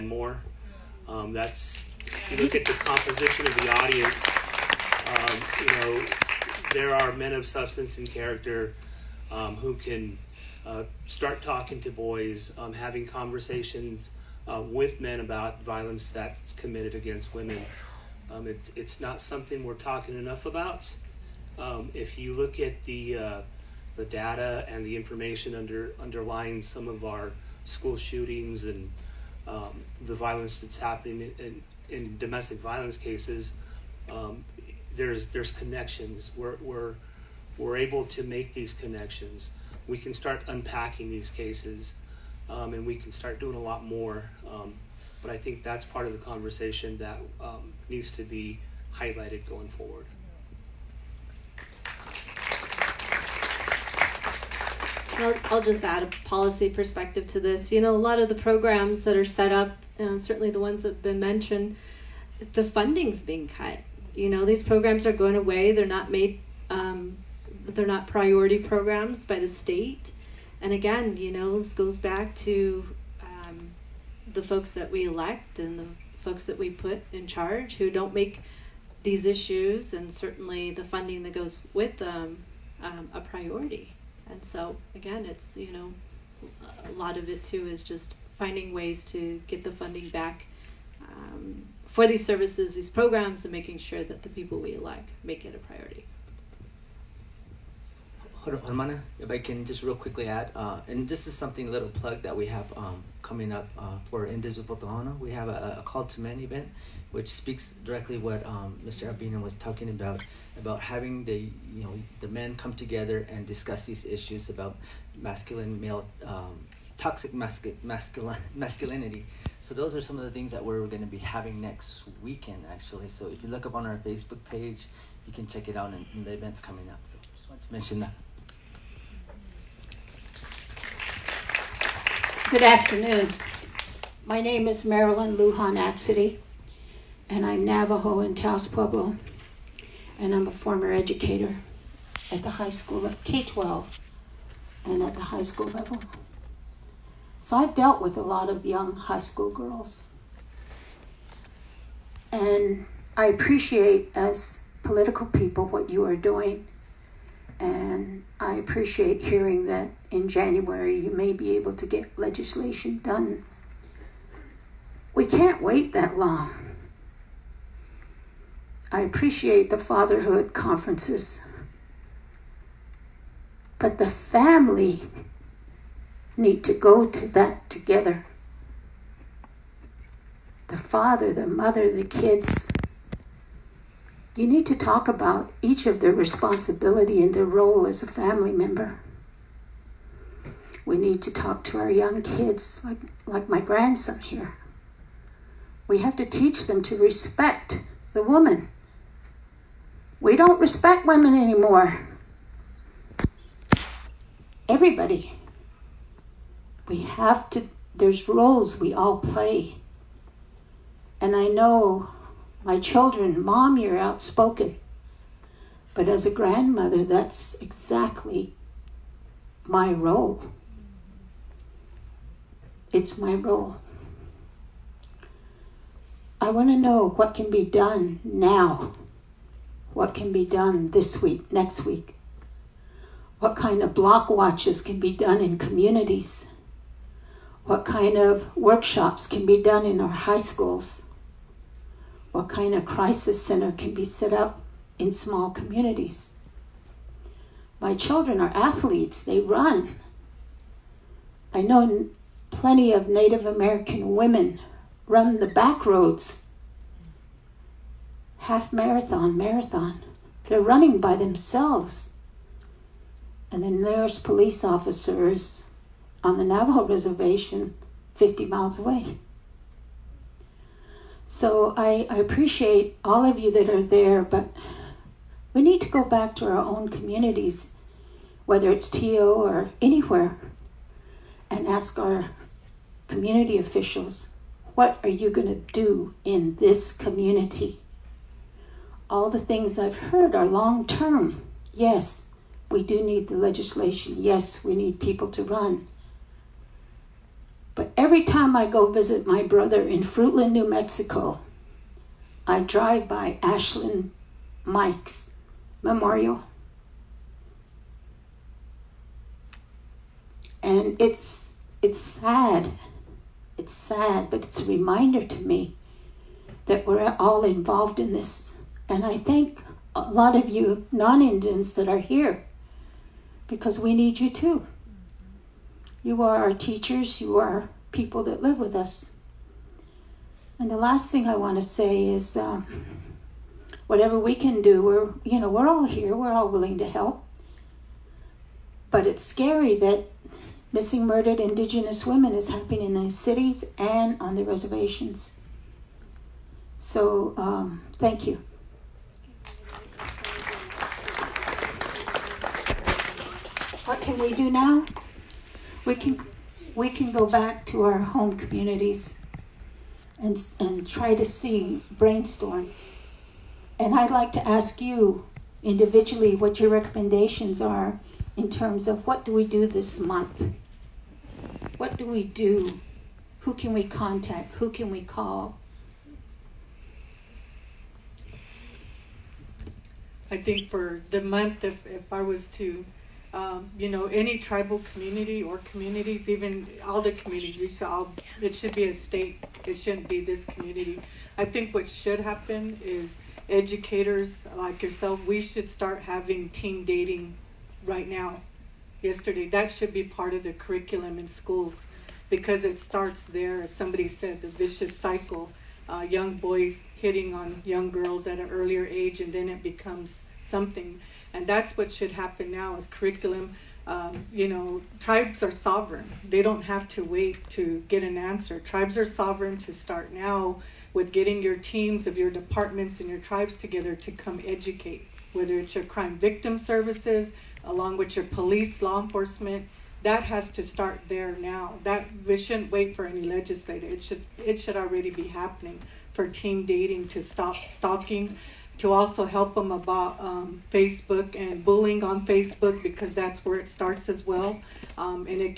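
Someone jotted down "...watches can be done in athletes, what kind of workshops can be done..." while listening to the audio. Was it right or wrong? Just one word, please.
wrong.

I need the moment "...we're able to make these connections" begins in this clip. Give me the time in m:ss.
0:37.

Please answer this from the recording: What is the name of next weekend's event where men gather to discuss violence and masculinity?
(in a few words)
Call to men.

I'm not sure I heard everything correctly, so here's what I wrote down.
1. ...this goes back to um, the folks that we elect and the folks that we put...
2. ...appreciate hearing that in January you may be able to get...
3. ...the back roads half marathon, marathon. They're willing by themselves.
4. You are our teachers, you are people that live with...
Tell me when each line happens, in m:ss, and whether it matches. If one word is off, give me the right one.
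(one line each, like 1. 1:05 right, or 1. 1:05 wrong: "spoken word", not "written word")
1. 1:11 right
2. 2:38 right
3. 4:15 wrong: "running", not "willing"
4. 5:26 right.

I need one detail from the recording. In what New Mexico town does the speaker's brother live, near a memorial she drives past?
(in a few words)
Fruitland.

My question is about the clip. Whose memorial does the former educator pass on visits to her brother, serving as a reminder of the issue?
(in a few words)
Ashlynne Mike.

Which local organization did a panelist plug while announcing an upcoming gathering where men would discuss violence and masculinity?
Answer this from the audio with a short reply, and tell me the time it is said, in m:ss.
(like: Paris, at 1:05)
Indivisible Tohono, at 1:44.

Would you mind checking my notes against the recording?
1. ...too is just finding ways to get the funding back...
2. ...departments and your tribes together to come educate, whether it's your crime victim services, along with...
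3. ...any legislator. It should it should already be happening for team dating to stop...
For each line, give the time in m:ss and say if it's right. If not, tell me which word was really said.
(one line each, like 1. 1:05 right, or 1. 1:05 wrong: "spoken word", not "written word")
1. 1:27 right
2. 7:02 right
3. 7:13 right.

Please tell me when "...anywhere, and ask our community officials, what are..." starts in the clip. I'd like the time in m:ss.
4:39.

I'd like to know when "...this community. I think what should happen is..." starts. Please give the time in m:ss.
6:30.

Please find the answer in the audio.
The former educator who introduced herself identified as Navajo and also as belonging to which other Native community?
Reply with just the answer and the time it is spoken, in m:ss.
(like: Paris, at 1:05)
Taos Pueblo, at 2:18.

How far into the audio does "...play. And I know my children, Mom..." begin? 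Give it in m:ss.
3:29.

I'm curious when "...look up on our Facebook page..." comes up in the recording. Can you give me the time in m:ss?
2:03.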